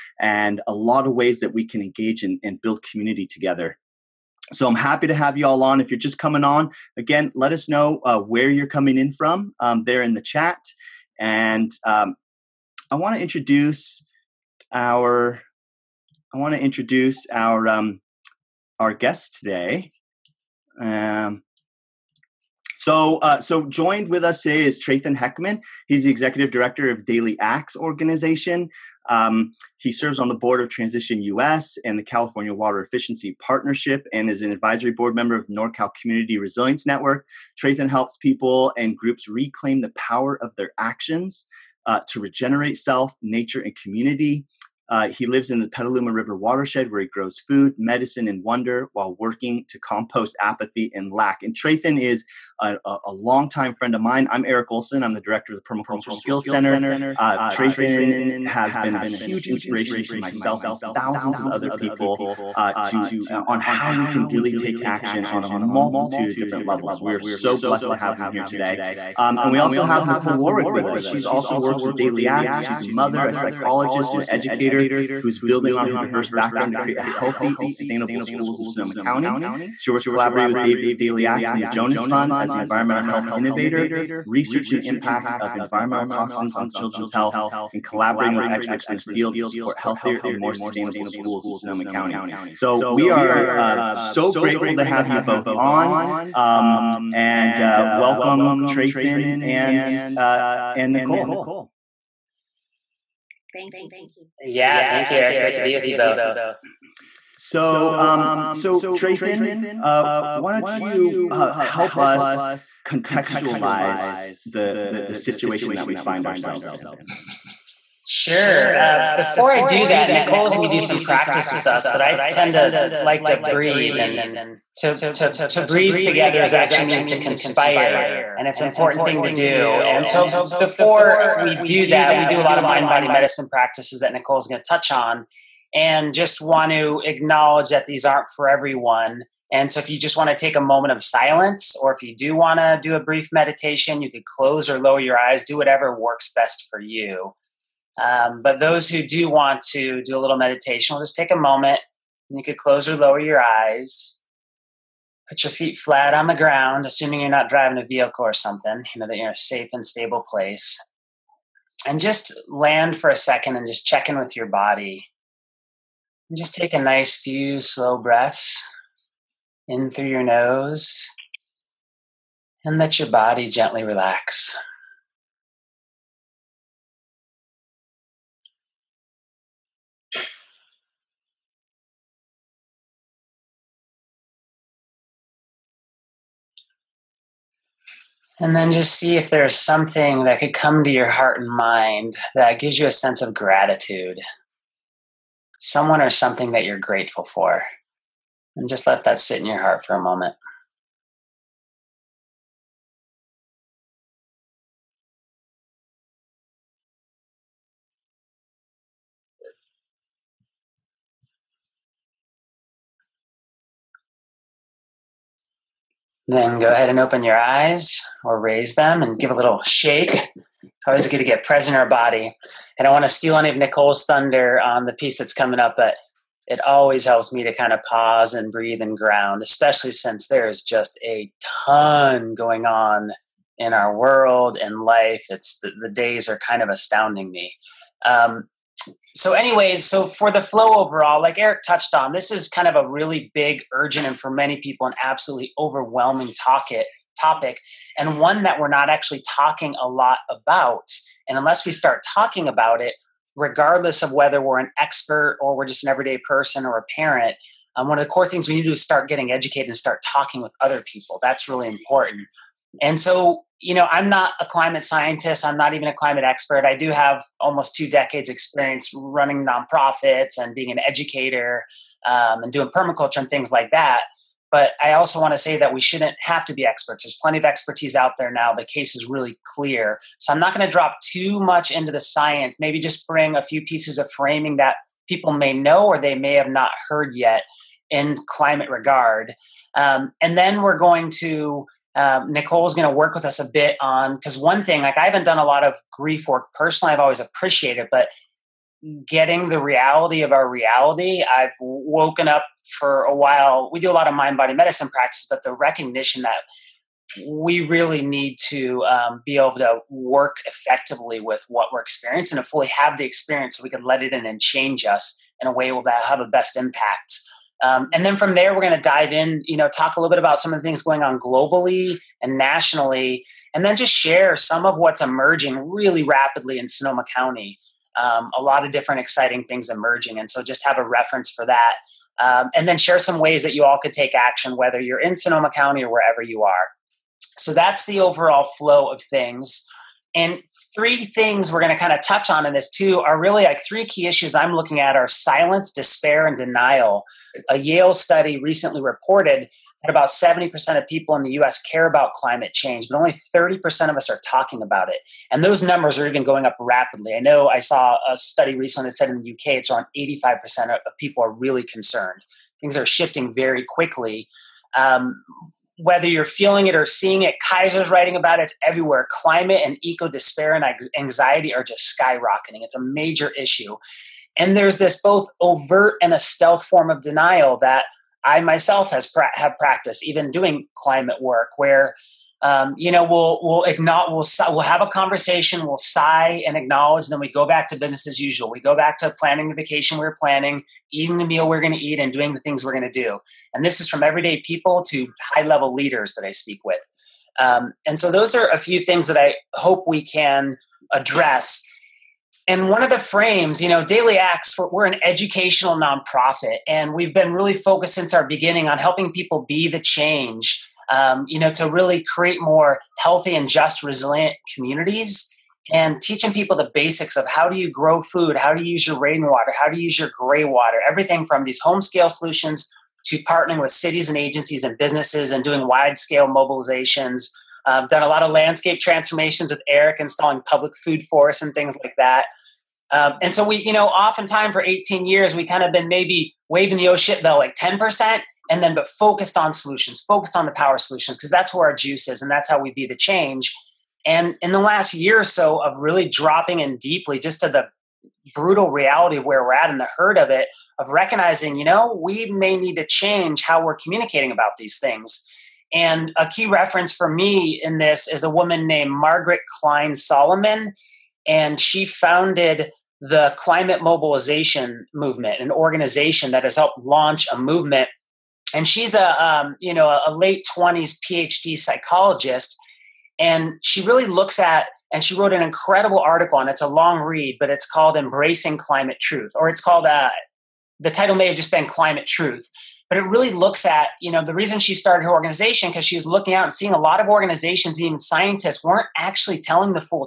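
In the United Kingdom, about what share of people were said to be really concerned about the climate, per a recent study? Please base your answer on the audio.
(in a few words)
85%.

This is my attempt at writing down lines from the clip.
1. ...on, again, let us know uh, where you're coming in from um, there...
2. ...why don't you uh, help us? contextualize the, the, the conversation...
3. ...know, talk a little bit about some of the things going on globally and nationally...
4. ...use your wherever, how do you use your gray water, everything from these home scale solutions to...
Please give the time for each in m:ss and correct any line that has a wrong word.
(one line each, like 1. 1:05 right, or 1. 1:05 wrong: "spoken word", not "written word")
1. 0:06 right
2. 1:50 wrong: "situation", not "conversation"
3. 5:19 right
4. 6:58 wrong: "rainwater", not "wherever".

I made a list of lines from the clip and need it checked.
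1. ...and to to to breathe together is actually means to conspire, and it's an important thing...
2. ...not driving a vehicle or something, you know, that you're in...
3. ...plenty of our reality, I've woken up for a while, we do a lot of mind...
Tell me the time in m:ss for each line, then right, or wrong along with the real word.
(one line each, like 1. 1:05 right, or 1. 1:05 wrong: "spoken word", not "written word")
1. 2:03 right
2. 2:37 right
3. 4:59 wrong: "reality", not "plenty".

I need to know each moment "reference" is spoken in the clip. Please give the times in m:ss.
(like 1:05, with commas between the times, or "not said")
5:30, 7:36.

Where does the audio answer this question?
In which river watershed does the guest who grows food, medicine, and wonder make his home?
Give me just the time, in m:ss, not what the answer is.
0:45.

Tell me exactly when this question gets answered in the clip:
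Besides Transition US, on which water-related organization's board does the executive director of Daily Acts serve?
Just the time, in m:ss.
0:32.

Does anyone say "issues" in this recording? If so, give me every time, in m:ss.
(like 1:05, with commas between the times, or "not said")
5:44, 6:13.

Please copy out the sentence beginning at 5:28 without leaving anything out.
Um, a lot of different exciting things emerging.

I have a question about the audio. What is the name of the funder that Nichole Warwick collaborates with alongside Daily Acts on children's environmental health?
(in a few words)
Jonas Fund.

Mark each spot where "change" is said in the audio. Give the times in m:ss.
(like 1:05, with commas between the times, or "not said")
5:14, 5:52, 6:49, 7:22, 7:32.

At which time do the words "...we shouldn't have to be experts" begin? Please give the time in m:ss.
4:35.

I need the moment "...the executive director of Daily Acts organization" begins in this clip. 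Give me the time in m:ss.
0:26.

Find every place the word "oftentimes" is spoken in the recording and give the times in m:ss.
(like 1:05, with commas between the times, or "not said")
7:13.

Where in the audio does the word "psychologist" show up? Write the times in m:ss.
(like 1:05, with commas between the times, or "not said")
1:13, 7:51.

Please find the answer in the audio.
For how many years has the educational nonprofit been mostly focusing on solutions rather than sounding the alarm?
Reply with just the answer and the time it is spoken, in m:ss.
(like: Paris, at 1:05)
18, at 7:14.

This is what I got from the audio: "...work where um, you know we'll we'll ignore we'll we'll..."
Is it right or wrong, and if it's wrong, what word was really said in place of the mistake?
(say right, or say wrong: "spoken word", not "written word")
right.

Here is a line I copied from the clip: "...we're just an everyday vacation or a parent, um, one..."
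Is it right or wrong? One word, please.
wrong.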